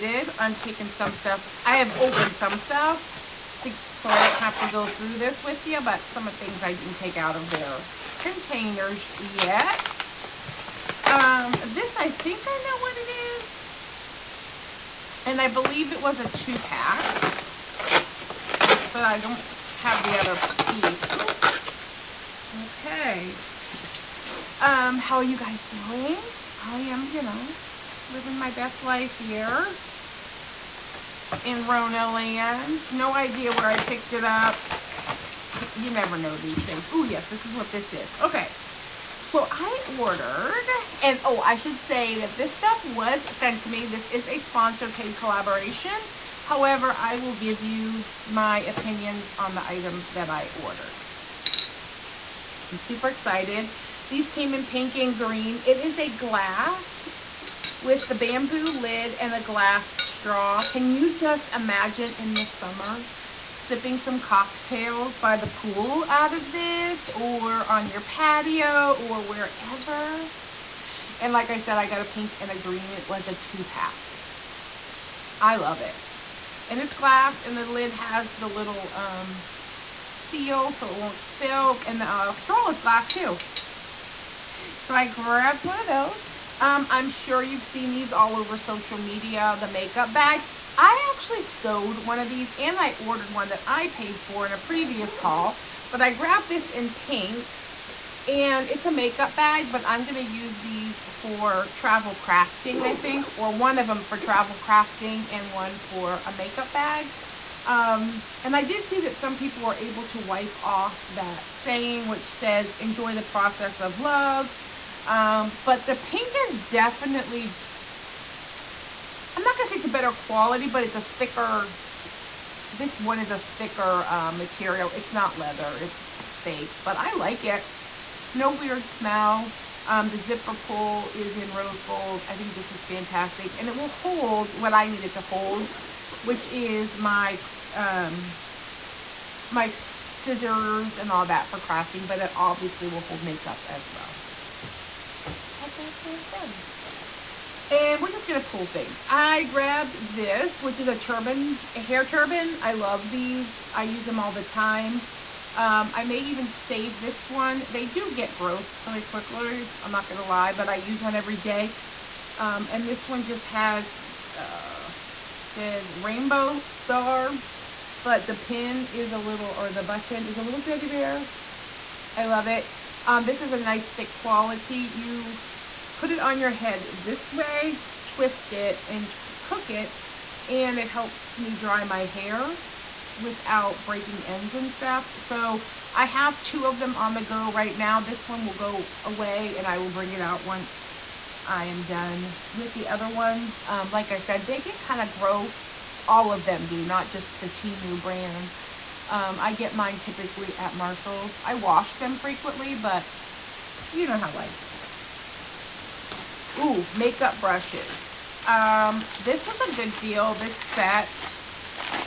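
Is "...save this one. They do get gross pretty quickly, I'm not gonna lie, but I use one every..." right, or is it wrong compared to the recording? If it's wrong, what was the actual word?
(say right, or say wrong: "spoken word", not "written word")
right.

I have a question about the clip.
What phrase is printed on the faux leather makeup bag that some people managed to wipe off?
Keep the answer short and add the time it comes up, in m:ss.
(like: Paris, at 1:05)
enjoy the process of love, at 1:52.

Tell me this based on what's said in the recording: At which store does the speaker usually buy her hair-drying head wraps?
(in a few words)
Marshall's.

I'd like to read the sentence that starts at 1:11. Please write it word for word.
And like I said, I got a pink and a green.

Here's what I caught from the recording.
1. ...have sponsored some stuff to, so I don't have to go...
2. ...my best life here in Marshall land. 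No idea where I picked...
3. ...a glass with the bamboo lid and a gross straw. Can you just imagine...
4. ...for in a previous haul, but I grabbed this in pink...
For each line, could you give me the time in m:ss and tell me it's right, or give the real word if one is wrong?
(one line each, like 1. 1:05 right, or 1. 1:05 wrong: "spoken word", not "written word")
1. 0:01 wrong: "opened", not "sponsored"
2. 0:28 wrong: "Rona", not "Marshall"
3. 0:55 wrong: "glass", not "gross"
4. 1:34 right.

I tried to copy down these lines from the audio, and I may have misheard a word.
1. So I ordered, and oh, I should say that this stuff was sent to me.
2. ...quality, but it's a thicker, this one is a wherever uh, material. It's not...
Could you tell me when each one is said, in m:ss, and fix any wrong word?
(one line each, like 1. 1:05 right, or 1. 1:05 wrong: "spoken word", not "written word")
1. 0:39 right
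2. 2:00 wrong: "thicker", not "wherever".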